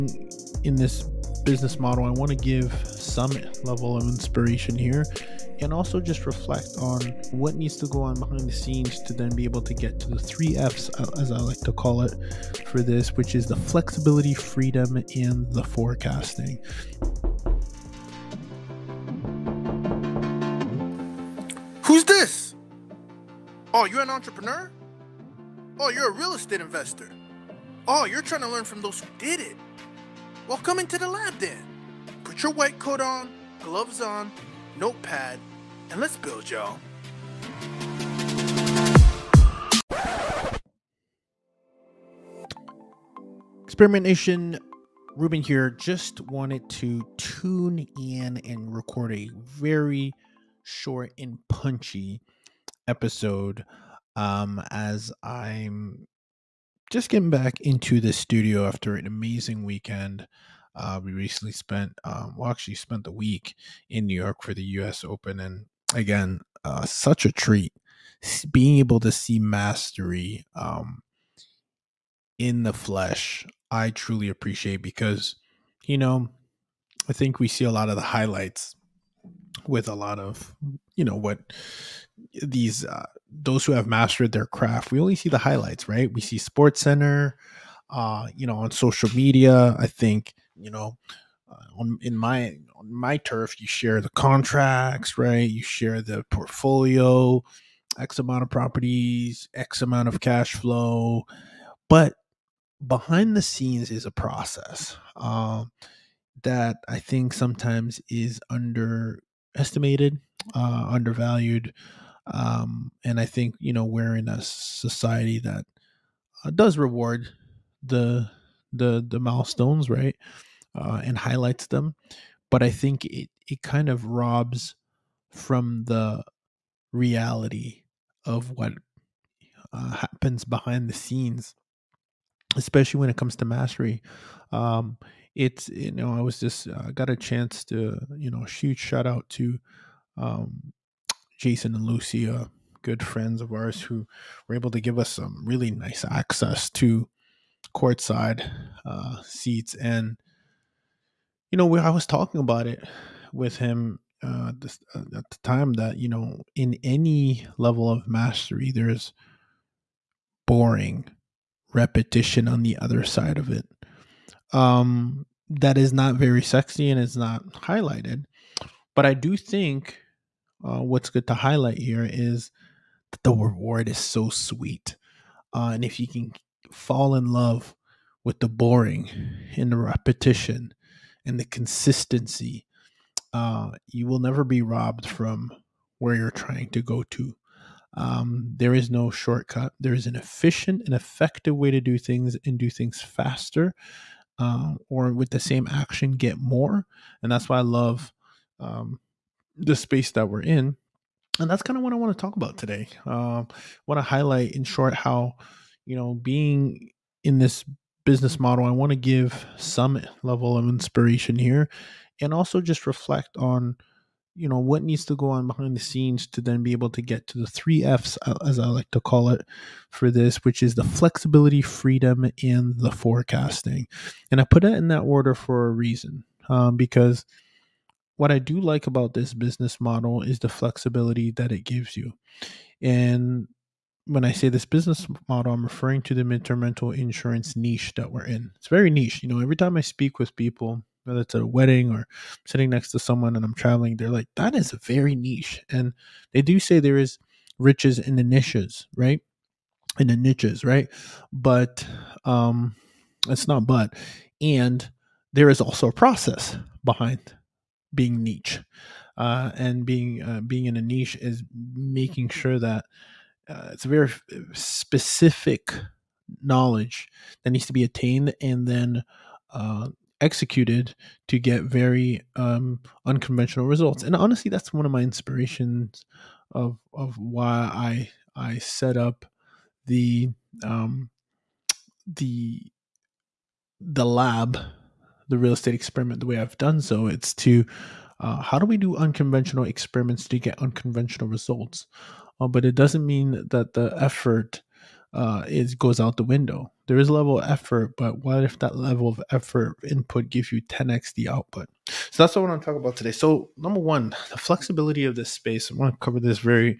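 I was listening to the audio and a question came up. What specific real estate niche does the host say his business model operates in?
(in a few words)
Midterm rental insurance.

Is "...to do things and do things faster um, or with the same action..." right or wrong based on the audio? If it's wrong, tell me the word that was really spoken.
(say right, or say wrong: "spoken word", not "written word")
right.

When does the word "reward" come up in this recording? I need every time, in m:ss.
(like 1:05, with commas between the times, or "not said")
1:56, 2:53.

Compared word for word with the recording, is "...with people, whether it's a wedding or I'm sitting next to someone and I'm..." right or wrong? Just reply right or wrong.
right.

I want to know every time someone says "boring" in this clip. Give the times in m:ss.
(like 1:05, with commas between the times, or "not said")
2:40, 2:58.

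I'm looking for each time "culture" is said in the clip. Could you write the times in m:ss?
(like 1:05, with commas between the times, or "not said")
not said.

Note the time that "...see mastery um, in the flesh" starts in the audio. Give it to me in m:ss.
1:09.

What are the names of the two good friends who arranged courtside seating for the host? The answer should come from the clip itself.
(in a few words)
Jason and Lucy.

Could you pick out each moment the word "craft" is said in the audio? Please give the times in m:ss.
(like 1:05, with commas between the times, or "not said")
1:24.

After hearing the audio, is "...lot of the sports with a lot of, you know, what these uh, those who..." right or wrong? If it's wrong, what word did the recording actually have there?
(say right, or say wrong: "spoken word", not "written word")
wrong: "highlights", not "sports".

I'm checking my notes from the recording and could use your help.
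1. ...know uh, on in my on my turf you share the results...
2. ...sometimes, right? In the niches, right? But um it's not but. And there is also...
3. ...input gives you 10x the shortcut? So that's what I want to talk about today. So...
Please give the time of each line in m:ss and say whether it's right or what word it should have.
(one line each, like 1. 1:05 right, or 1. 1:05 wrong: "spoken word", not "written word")
1. 1:30 wrong: "contracts", not "results"
2. 4:08 wrong: "niches", not "sometimes"
3. 4:59 wrong: "output", not "shortcut".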